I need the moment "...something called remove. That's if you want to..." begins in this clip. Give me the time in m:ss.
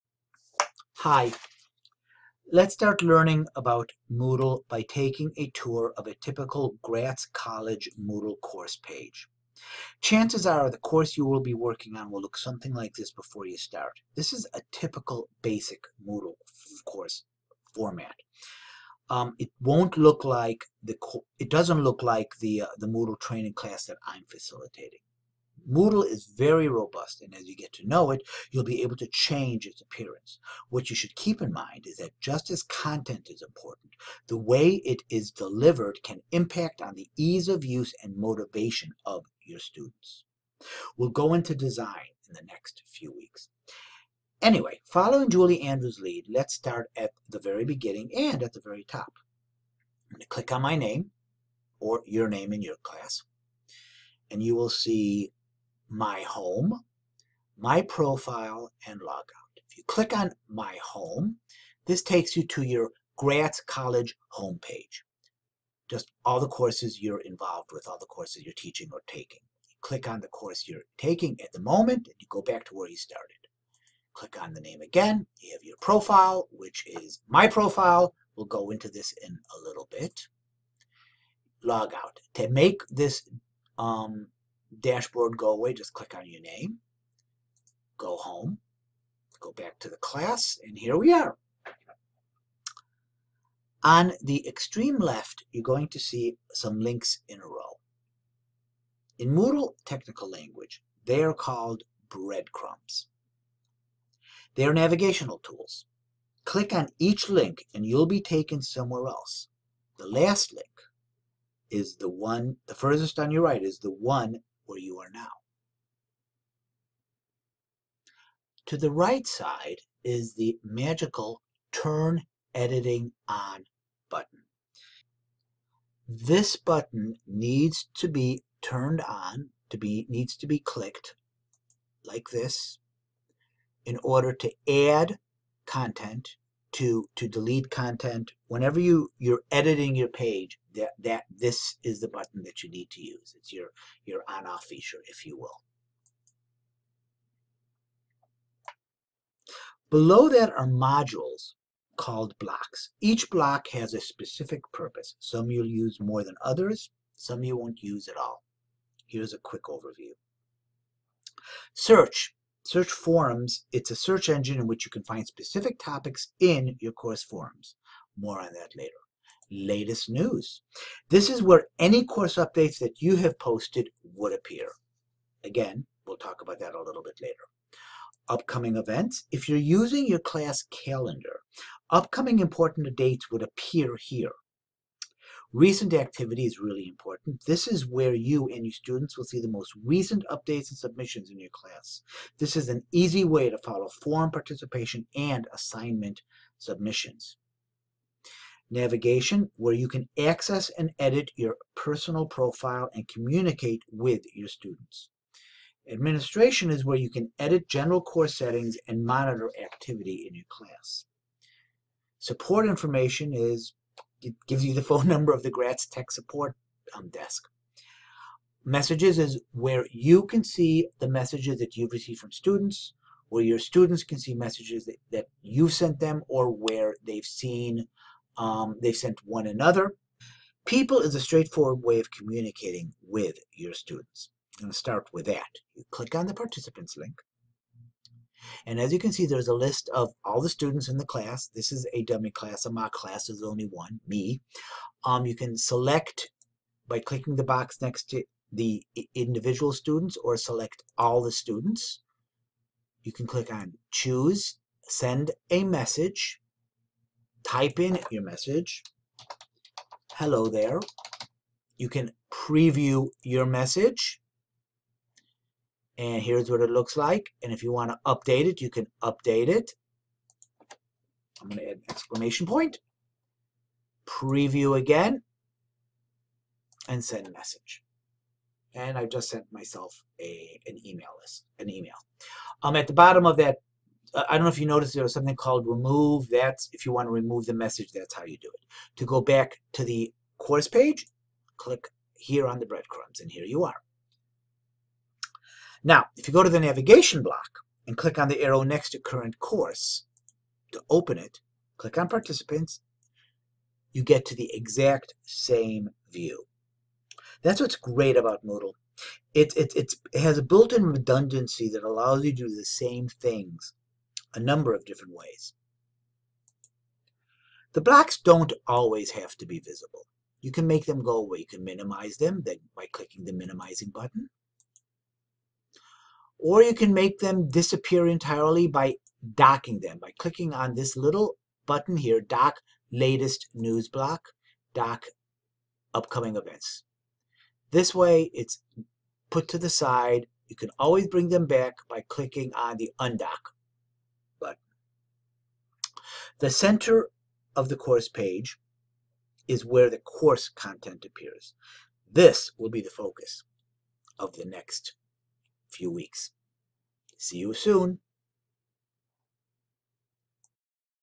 4:45.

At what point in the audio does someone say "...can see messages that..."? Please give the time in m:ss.
3:44.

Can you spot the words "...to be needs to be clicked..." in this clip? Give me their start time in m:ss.
2:09.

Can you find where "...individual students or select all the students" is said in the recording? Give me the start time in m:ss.
4:09.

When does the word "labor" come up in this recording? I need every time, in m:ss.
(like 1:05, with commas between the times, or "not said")
not said.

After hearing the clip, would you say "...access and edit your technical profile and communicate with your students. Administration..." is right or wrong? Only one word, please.
wrong.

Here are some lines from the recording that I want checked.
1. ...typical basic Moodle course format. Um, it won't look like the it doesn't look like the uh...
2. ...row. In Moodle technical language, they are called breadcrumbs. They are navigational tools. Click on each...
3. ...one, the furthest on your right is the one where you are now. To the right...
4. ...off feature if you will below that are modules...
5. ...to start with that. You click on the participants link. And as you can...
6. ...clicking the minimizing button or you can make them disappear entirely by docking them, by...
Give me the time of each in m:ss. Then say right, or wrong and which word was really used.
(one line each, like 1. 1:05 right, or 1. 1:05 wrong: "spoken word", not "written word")
1. 0:14 right
2. 1:37 right
3. 1:52 right
4. 2:24 right
5. 3:54 right
6. 5:22 right.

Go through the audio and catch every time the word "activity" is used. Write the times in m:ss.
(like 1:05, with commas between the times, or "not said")
3:05, 3:29.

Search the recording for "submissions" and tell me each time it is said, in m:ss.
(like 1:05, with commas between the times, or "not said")
3:10, 3:16.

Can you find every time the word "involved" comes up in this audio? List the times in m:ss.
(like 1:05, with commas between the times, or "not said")
1:07.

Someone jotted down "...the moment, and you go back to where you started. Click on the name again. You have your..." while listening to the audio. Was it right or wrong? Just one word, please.
right.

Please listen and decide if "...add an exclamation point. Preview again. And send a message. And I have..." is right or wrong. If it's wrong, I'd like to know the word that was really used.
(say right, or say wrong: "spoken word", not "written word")
right.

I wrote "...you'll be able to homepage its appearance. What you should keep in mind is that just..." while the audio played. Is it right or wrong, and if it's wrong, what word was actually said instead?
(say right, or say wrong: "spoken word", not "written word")
wrong: "change", not "homepage".